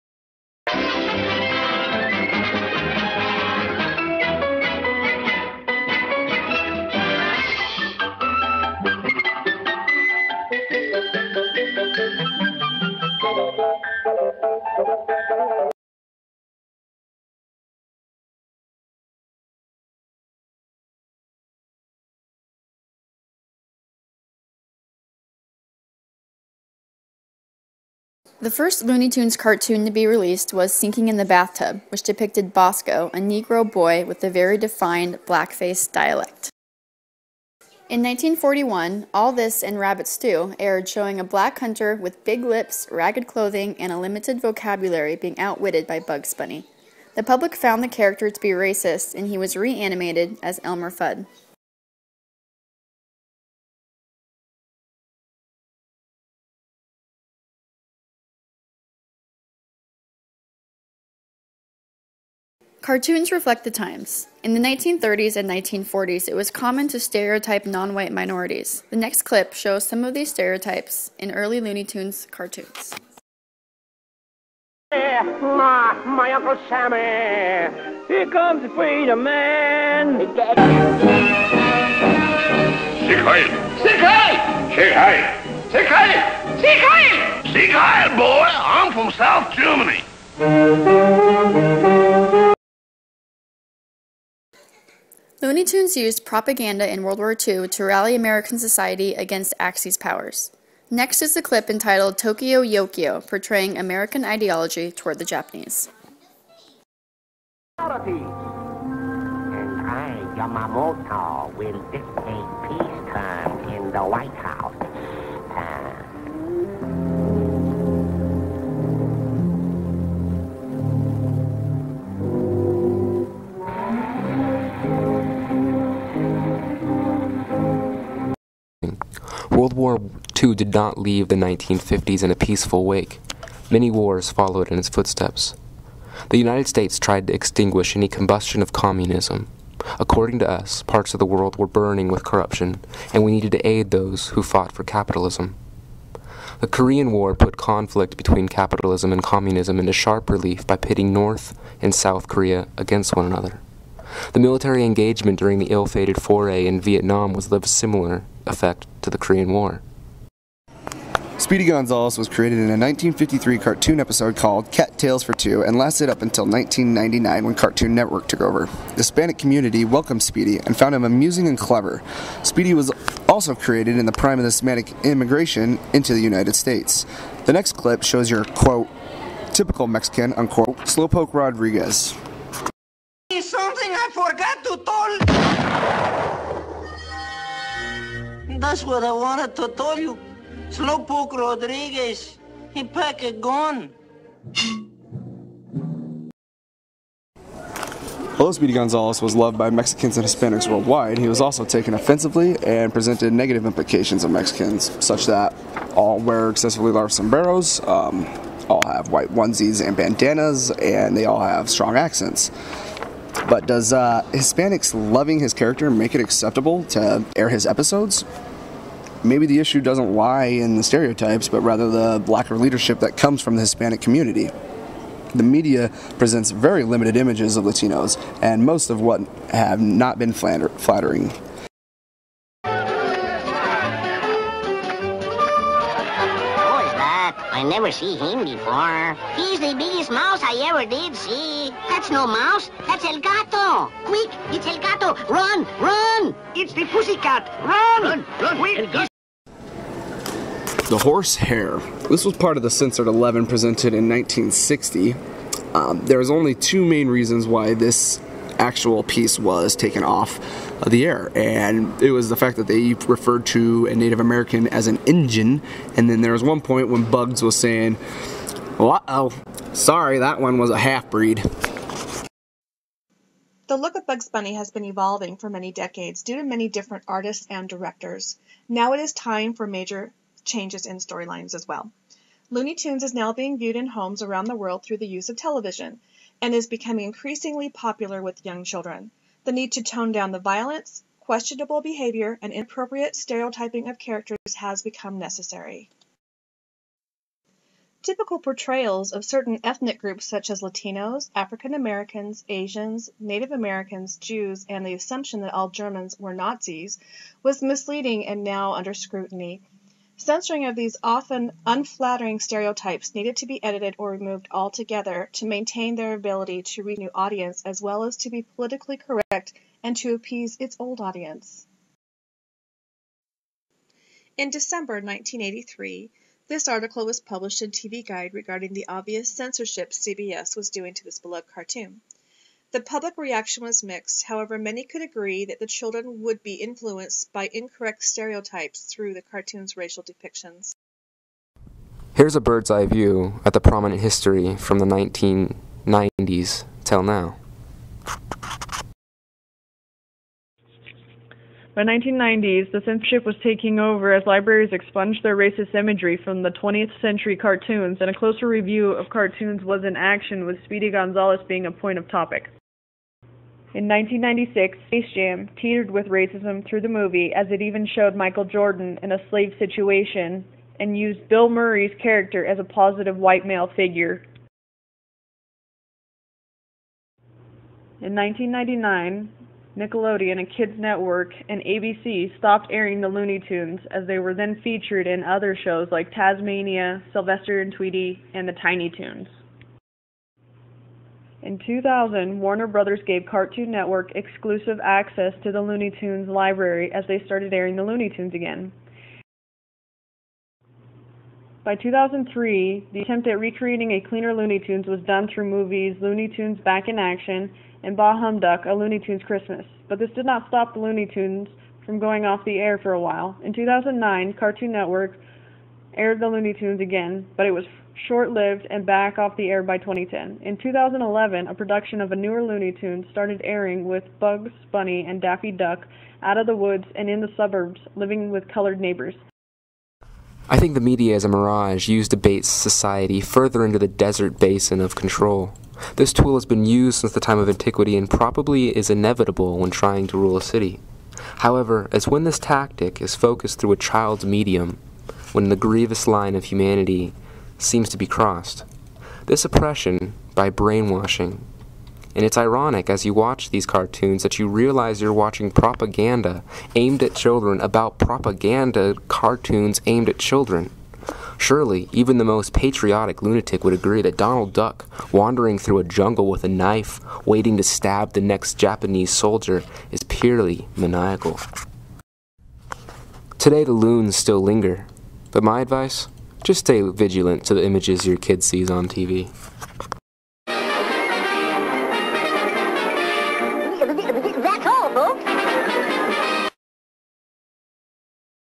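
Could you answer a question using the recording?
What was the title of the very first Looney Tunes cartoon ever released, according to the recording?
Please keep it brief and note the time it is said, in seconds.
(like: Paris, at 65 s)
Sinking in the Bathtub, at 30 s.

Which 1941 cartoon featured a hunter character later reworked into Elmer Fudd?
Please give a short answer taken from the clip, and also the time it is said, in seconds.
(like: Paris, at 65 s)
All This and Rabbit Stew, at 39 s.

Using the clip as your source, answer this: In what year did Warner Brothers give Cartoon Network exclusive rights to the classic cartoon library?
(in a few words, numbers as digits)
2000.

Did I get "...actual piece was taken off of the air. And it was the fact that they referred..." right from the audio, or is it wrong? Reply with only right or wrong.
right.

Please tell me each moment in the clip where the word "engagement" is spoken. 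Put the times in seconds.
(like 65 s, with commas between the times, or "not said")
154 s.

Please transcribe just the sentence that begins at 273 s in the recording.
The look of Bugs Bunny has been evolving for many decades due to many different artists and directors.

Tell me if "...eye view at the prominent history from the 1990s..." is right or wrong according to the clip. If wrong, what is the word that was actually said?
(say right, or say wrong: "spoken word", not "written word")
right.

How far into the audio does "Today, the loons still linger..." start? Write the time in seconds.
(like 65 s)
473 s.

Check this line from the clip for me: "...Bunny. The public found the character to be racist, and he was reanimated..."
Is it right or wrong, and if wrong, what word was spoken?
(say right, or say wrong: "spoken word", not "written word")
right.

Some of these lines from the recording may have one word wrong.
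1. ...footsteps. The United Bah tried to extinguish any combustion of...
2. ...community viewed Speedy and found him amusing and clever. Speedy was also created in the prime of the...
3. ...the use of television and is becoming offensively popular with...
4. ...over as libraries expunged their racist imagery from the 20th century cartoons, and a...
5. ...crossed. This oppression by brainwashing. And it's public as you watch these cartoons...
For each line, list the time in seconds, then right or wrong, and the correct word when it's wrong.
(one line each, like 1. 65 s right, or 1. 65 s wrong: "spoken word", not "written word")
1. 134 s wrong: "States", not "Bah"
2. 169 s wrong: "welcomed", not "viewed"
3. 284 s wrong: "increasingly", not "offensively"
4. 353 s right
5. 448 s wrong: "ironic", not "public".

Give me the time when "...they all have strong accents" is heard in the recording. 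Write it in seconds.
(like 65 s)
211 s.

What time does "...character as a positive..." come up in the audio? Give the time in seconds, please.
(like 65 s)
372 s.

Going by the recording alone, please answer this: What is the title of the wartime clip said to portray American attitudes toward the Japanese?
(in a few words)
Tokio Jokio.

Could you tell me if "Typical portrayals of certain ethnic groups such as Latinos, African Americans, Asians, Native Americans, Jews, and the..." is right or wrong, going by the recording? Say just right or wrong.
right.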